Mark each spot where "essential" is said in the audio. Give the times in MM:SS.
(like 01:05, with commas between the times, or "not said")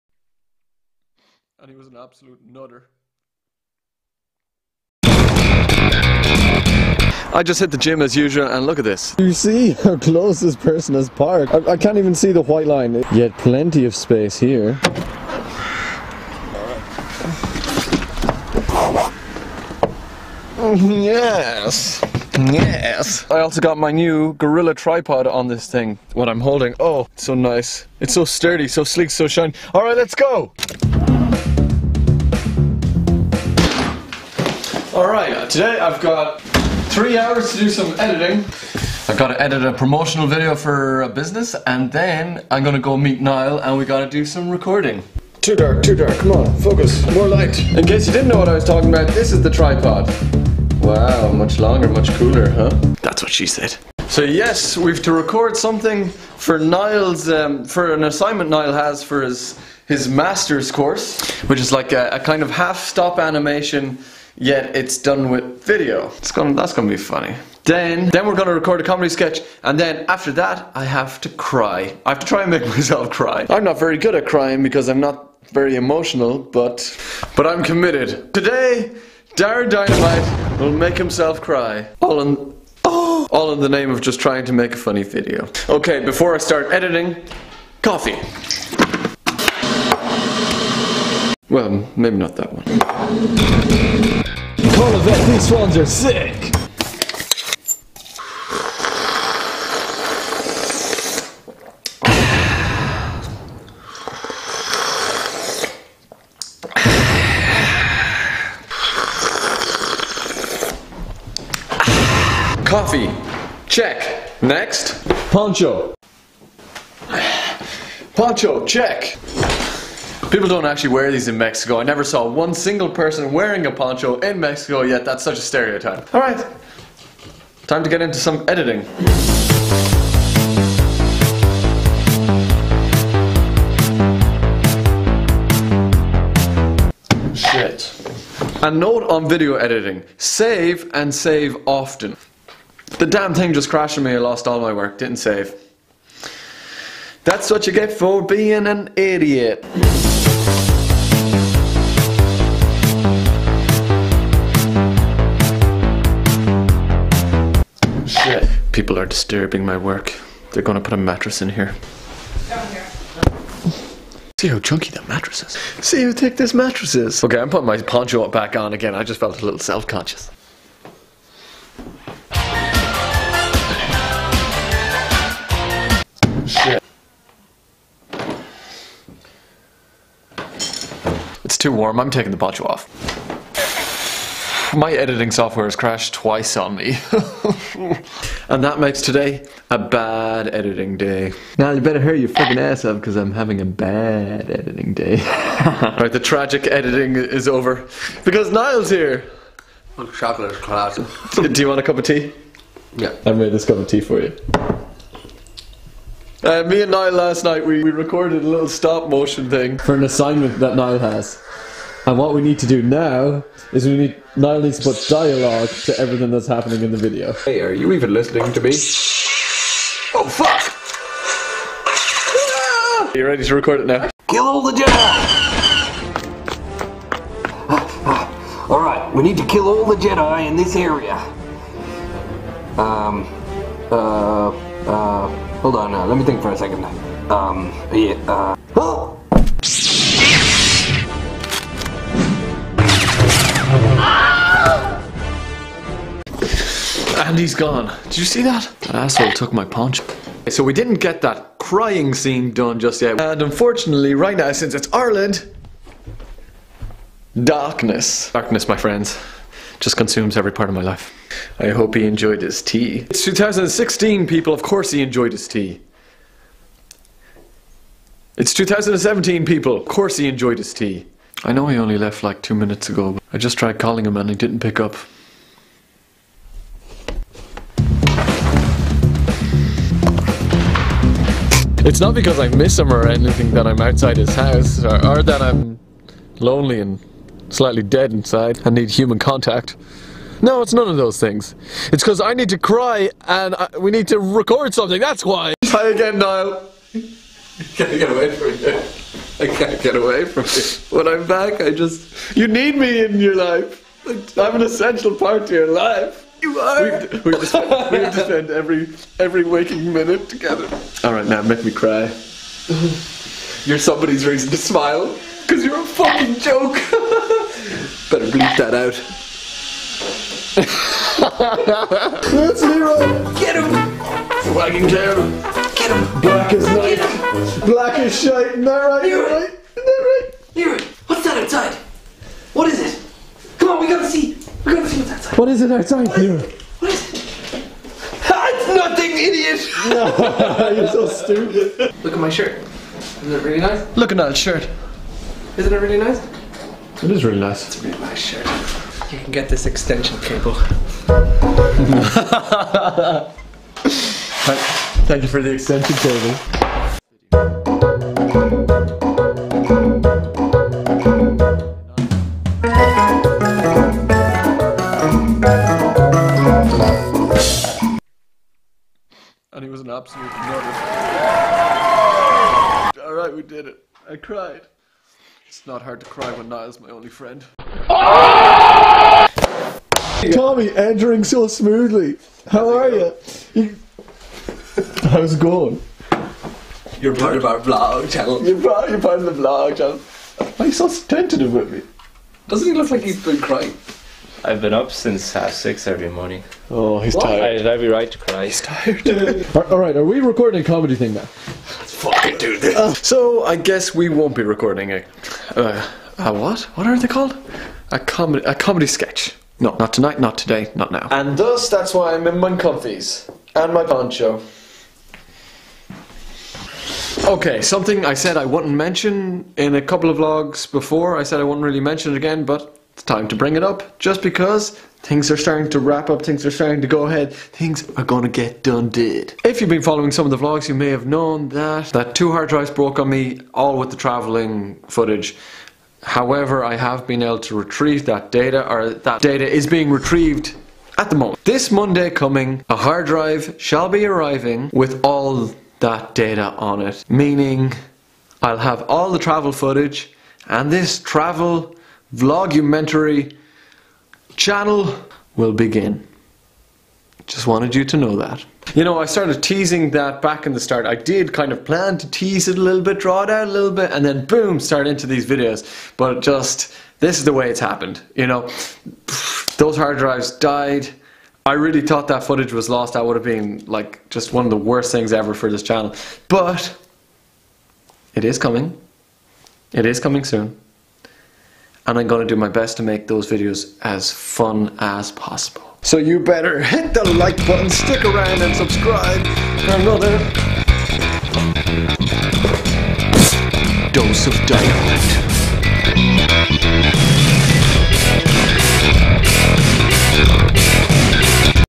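05:04.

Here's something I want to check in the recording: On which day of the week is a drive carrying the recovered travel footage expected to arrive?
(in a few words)
Monday.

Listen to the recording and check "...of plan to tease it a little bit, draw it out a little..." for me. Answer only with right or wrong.
right.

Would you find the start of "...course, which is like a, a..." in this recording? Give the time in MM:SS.
01:00.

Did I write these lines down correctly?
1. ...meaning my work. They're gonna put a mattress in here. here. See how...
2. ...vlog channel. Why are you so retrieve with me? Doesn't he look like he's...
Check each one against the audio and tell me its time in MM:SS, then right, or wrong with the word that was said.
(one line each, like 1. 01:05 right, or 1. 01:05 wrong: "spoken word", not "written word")
1. 02:39 wrong: "disturbing", not "meaning"
2. 06:29 wrong: "tentative", not "retrieve".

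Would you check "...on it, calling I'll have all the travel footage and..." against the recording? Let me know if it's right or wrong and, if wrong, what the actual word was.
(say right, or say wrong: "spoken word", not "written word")
wrong: "meaning", not "calling".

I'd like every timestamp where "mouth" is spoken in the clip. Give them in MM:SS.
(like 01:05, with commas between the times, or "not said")
not said.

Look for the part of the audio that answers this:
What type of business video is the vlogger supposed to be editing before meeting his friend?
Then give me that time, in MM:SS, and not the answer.
00:39.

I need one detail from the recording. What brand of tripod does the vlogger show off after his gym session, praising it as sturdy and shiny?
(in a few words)
Gorilla.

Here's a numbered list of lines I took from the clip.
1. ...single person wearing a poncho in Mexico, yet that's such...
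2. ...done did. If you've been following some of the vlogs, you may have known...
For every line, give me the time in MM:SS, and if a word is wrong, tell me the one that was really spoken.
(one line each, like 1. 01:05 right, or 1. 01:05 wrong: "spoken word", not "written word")
1. 02:02 right
2. 07:08 right.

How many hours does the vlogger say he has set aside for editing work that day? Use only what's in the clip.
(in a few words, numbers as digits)
3.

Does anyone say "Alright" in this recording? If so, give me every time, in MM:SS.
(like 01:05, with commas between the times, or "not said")
00:34, 02:06, 03:48, 06:13.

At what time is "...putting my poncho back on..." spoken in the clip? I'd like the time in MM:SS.
02:47.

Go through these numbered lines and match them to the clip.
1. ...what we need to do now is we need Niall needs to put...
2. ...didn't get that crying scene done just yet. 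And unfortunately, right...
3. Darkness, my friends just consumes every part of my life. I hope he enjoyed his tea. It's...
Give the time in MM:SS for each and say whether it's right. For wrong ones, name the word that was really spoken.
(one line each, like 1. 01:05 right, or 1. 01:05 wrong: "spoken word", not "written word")
1. 03:32 right
2. 04:10 right
3. 04:18 right.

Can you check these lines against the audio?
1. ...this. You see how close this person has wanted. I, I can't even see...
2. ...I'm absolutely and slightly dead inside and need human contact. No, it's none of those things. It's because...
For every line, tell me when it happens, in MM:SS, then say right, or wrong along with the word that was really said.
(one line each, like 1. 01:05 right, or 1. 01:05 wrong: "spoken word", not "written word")
1. 00:08 wrong: "parked", not "wanted"
2. 04:45 wrong: "lonely", not "absolutely".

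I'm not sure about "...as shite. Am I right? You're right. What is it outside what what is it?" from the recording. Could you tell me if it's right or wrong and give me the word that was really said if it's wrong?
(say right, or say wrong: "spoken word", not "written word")
right.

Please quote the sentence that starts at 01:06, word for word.
It's gonna, that's gonna be funny.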